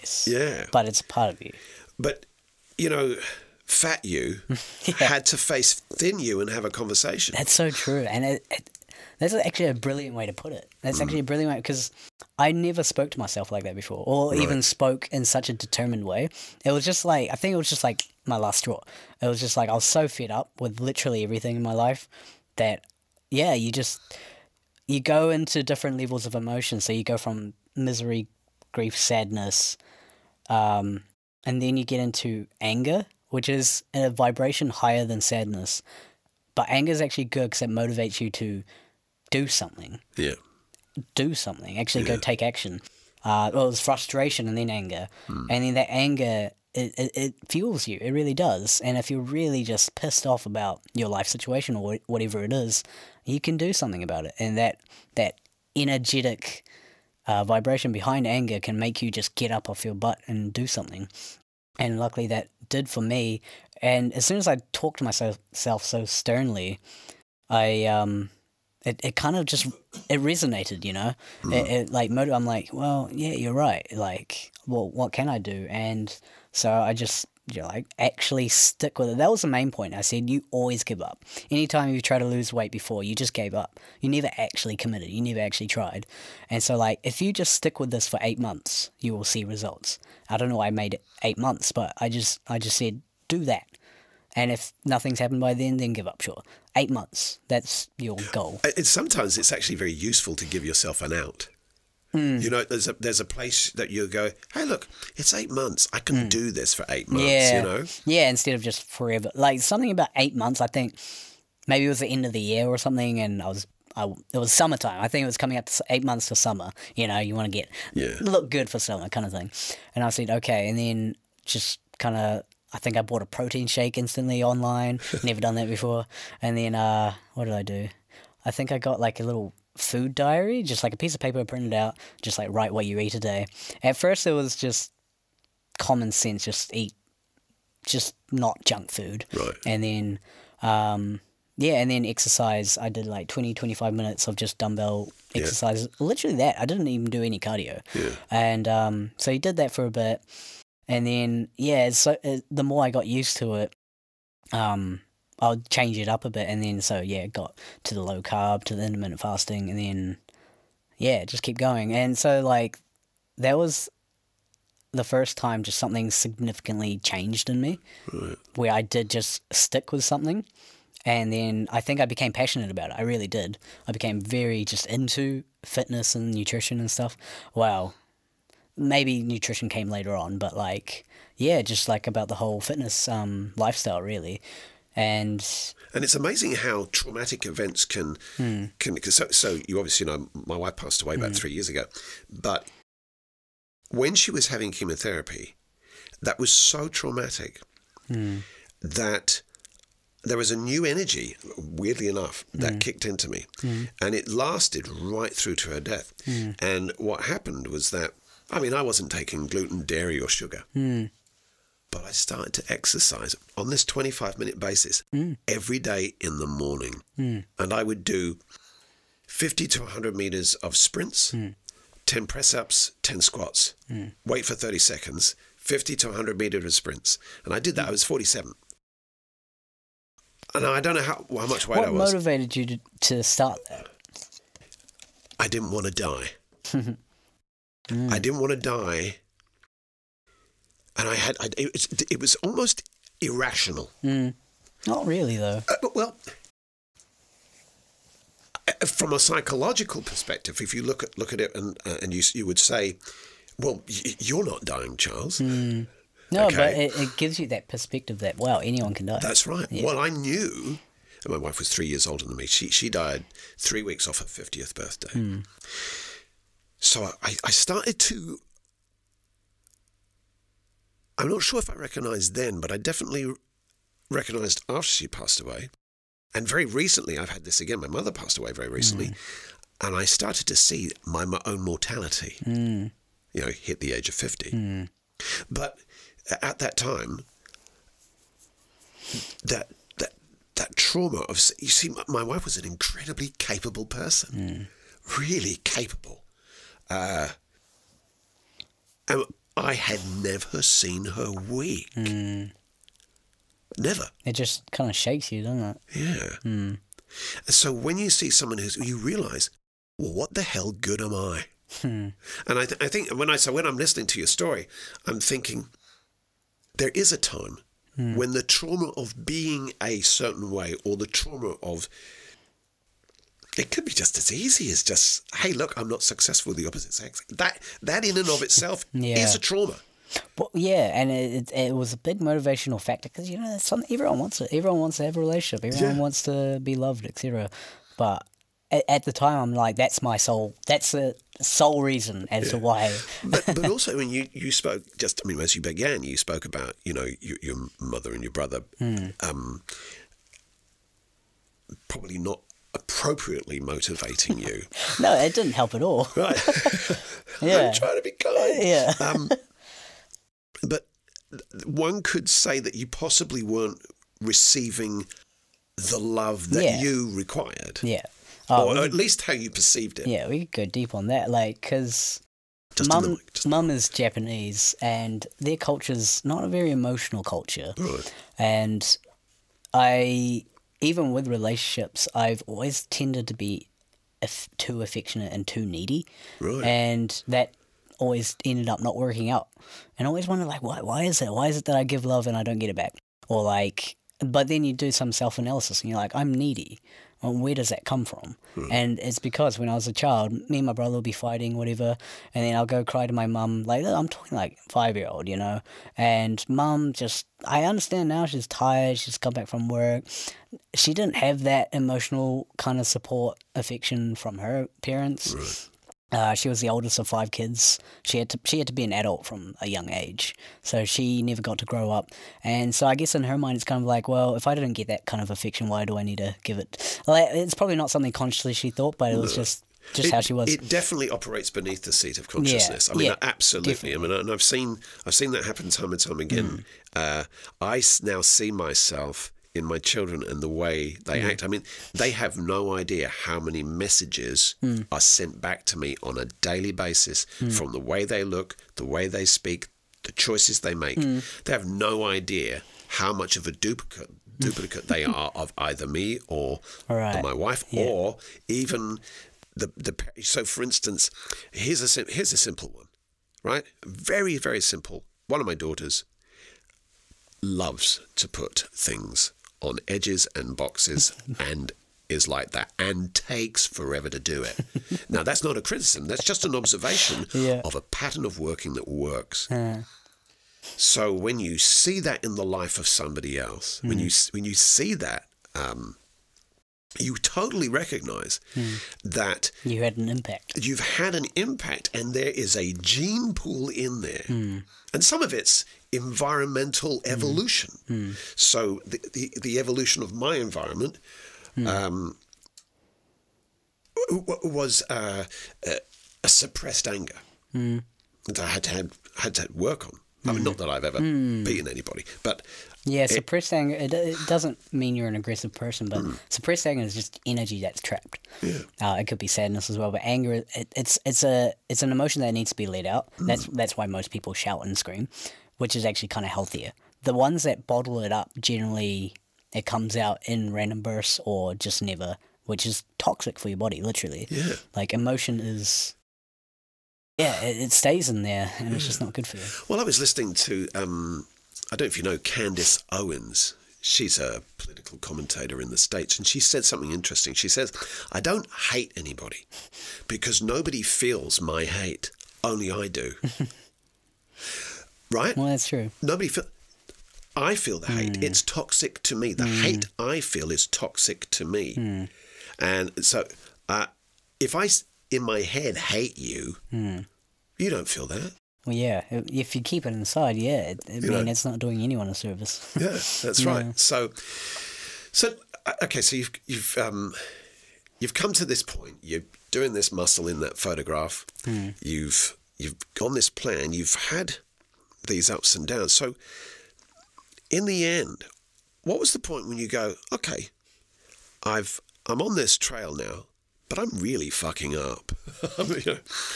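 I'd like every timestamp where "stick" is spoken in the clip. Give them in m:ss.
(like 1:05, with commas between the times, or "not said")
1:18, 1:27, 2:49.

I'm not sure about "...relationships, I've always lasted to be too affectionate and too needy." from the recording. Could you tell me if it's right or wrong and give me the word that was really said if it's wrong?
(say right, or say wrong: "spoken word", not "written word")
wrong: "tended", not "lasted".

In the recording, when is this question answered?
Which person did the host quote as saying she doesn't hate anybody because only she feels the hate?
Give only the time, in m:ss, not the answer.
9:02.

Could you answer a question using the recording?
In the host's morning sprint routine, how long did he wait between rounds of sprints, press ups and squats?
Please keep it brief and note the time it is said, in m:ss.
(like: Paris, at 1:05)
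30 seconds, at 3:44.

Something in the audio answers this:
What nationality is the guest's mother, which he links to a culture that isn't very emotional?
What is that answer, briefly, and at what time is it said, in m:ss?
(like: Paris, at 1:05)
Japanese, at 6:13.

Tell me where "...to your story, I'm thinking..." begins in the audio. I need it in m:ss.
5:14.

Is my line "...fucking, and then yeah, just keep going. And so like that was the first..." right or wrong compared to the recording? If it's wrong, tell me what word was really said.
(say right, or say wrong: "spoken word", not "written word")
wrong: "fasting", not "fucking".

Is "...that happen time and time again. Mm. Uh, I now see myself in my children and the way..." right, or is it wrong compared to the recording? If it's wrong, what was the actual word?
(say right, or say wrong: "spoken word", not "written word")
right.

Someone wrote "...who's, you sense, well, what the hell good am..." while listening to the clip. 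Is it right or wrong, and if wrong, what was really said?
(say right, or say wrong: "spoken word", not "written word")
wrong: "realise", not "sense".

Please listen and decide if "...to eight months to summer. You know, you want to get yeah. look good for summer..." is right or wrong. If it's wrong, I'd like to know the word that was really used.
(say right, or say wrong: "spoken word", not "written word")
right.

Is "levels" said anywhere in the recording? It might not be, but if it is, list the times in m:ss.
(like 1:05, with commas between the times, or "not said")
0:25.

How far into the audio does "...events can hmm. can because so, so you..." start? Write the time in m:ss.
3:07.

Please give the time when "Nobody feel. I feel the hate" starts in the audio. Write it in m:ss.
9:16.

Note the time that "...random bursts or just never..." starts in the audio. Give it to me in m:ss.
8:50.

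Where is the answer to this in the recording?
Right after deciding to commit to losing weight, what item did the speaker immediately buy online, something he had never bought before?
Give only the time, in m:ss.
2:03.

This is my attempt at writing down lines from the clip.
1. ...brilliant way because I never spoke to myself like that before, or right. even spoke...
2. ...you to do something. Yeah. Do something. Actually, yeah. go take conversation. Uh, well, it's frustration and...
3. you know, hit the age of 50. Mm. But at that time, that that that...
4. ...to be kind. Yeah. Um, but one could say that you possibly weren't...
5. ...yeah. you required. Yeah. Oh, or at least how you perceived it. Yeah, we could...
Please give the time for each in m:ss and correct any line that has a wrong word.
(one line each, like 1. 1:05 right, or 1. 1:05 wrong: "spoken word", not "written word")
1. 0:11 right
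2. 0:38 wrong: "action", not "conversation"
3. 4:43 right
4. 5:57 right
5. 6:06 right.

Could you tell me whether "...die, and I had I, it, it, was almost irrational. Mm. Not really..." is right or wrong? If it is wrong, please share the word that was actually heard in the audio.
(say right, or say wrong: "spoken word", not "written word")
right.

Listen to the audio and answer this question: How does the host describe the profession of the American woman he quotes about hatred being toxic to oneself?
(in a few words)
Political commentator.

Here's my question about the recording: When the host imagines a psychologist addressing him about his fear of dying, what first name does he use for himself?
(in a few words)
Charles.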